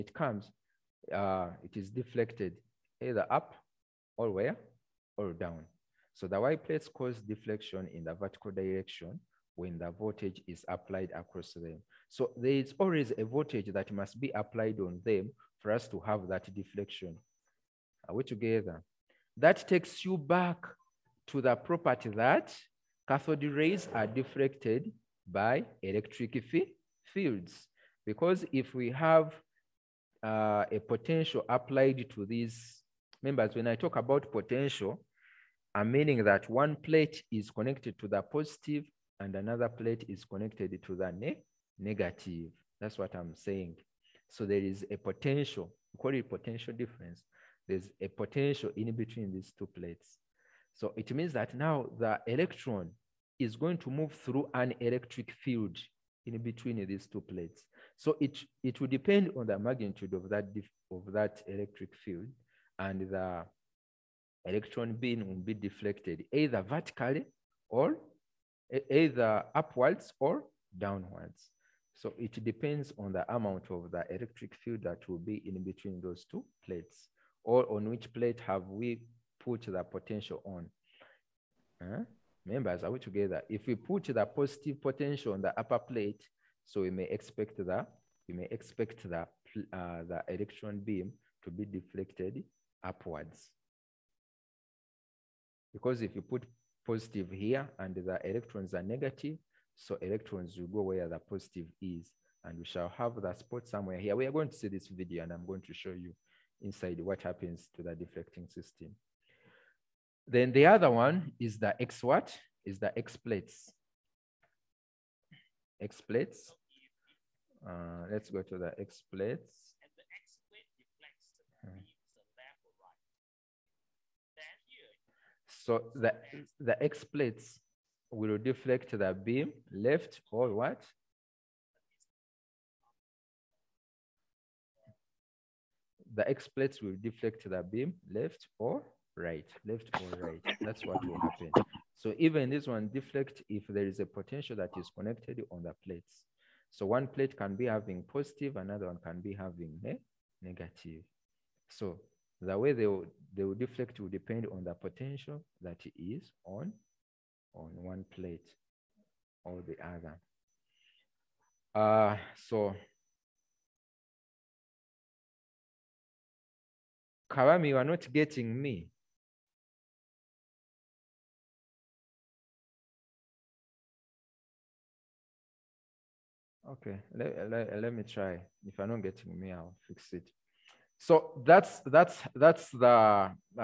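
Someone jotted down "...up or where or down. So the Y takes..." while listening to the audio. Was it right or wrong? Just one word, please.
wrong.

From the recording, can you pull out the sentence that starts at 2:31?
So the way they will, they will deflect will depend on the potential that is on, on one plate or the other.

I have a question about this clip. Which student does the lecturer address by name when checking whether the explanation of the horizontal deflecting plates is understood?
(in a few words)
Kawami.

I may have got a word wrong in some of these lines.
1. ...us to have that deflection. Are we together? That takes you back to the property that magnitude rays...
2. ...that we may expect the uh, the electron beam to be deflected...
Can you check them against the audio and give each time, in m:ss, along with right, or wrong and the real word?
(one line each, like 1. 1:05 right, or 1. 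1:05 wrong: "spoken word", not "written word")
1. 0:15 wrong: "cathode", not "magnitude"
2. 1:27 right.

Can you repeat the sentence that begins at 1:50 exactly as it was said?
Then the other one is the X what?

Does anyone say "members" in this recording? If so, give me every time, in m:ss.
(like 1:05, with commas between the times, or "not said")
0:33, 1:22.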